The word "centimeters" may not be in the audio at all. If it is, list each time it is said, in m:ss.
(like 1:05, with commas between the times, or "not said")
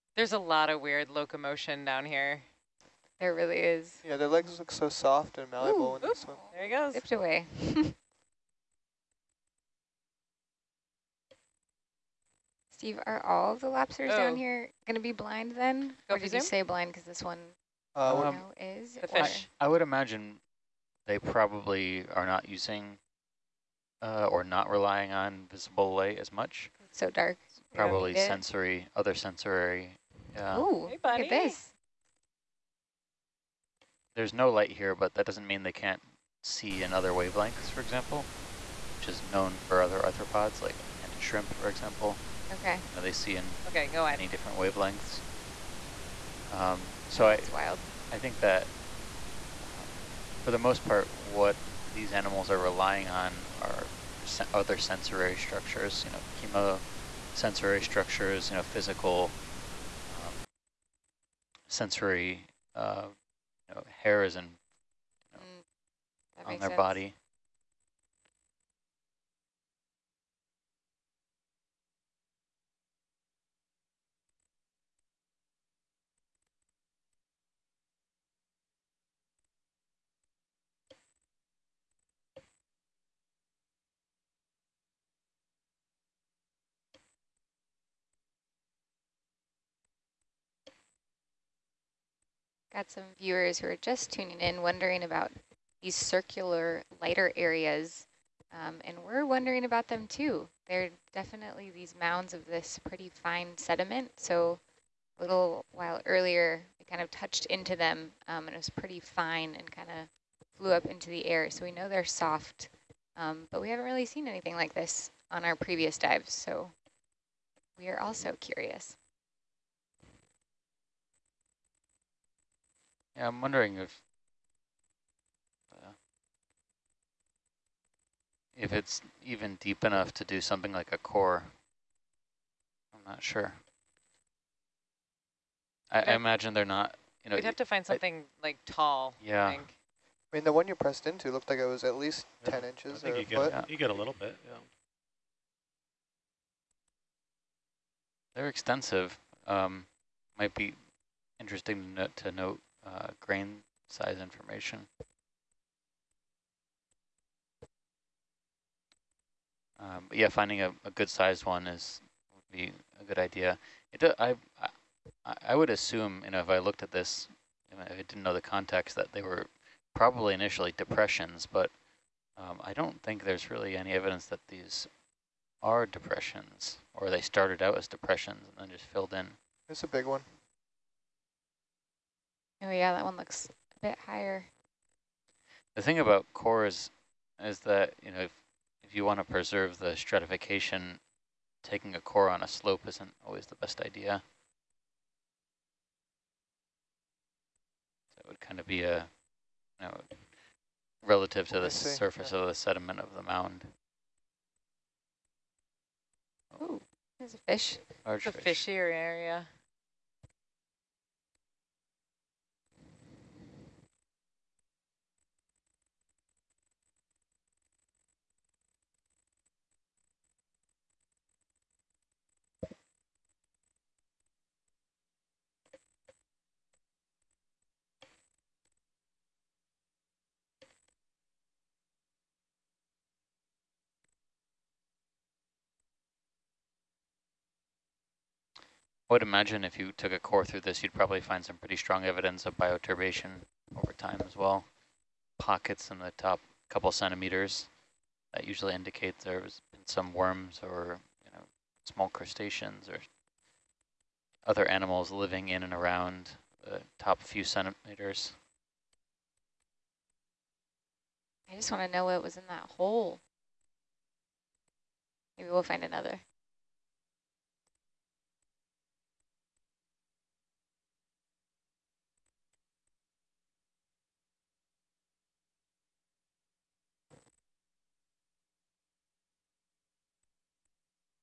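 4:06, 4:17.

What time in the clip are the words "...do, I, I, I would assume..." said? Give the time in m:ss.
2:44.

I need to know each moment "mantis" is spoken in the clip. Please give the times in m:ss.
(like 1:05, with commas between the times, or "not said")
0:41.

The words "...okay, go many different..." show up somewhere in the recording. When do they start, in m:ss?
0:43.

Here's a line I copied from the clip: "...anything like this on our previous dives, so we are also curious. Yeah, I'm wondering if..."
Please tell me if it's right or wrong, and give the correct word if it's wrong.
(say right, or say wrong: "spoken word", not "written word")
right.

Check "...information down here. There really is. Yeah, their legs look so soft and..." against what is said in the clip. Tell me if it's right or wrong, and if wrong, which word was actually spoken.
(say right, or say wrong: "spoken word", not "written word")
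wrong: "locomotion", not "information".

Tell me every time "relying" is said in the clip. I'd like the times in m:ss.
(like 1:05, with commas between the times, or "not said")
0:24, 0:52.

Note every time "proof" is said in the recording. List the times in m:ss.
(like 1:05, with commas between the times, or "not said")
not said.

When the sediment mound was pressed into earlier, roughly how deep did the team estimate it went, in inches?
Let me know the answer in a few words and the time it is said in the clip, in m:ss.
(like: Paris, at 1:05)
10 inches, at 2:22.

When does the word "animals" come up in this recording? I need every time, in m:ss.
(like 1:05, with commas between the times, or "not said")
0:52, 4:14.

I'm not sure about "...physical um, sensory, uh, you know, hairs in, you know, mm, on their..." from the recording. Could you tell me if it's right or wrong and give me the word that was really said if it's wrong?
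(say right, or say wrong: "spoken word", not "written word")
right.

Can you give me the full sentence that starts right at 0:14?
down here going to be blind then?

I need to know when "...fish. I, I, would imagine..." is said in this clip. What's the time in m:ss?
0:19.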